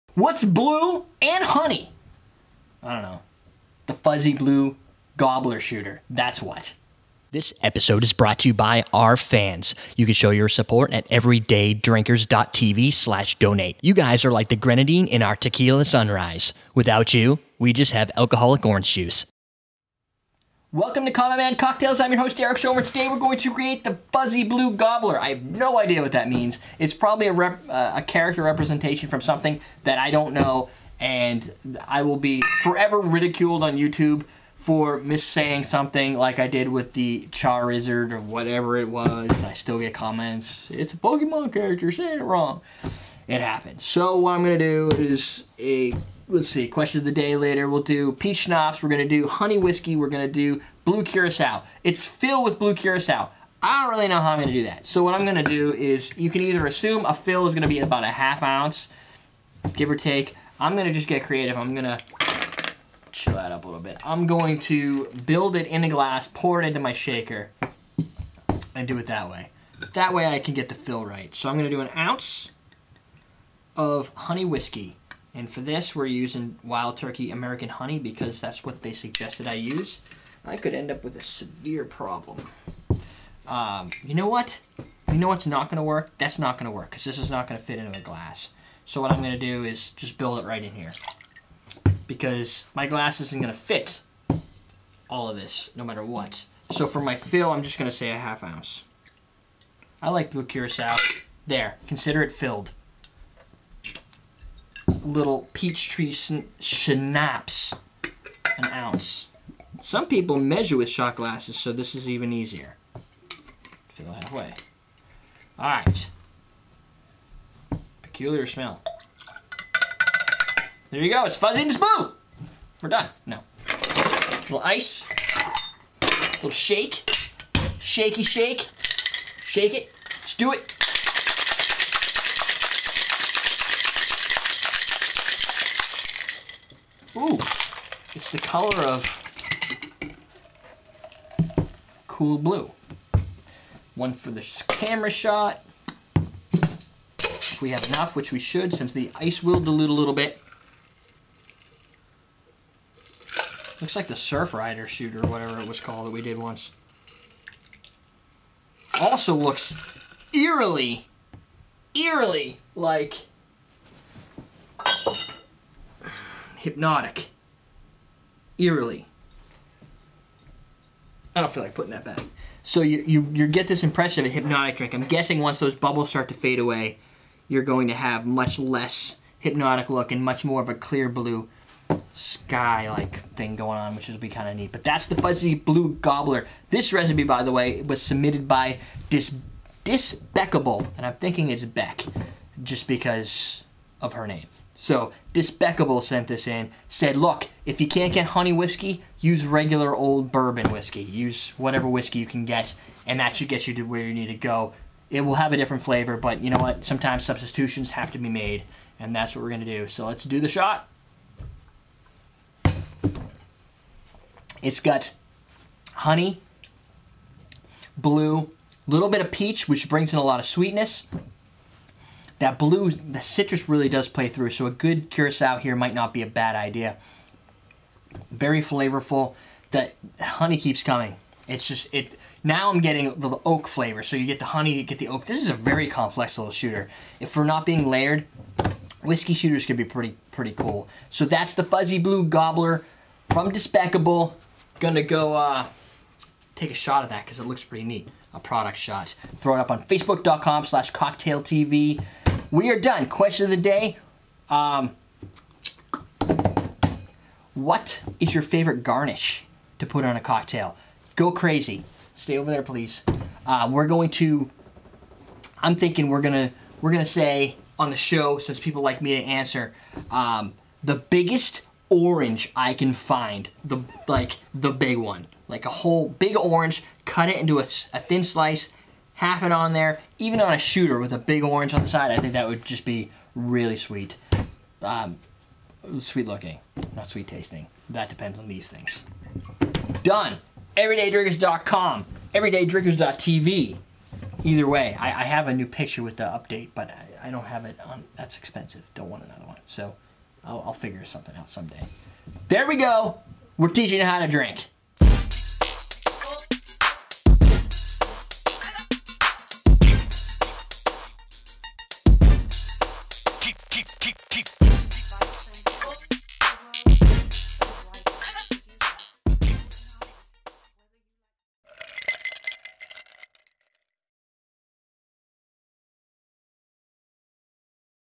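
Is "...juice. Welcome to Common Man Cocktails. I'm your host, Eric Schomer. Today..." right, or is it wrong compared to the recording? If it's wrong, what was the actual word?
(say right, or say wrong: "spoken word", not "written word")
right.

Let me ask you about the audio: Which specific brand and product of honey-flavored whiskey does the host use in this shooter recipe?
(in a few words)
Wild Turkey American Honey.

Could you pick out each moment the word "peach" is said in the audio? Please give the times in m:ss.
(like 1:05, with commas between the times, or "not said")
0:48, 1:45, 3:39.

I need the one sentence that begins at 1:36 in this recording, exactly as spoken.
So for my fill, I'm just going to say a half ounce.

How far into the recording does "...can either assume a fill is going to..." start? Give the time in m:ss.
0:56.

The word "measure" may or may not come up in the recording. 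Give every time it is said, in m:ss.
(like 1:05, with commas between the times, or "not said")
1:50.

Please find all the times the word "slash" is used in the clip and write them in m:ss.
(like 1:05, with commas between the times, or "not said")
0:12, 4:10.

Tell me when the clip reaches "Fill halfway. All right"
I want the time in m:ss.
1:53.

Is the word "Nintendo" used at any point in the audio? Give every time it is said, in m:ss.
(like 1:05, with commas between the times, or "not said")
not said.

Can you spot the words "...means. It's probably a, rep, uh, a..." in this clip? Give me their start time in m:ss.
0:26.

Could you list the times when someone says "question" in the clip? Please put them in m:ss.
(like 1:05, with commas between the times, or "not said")
0:46, 4:13.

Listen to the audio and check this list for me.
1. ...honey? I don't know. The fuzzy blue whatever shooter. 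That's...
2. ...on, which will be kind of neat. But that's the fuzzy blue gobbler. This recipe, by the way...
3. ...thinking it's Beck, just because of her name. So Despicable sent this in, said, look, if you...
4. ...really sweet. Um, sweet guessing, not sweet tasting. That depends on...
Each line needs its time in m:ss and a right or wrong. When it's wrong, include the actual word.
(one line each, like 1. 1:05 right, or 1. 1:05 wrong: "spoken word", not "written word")
1. 0:01 wrong: "gobbler", not "whatever"
2. 3:03 right
3. 3:11 right
4. 4:43 wrong: "looking", not "guessing".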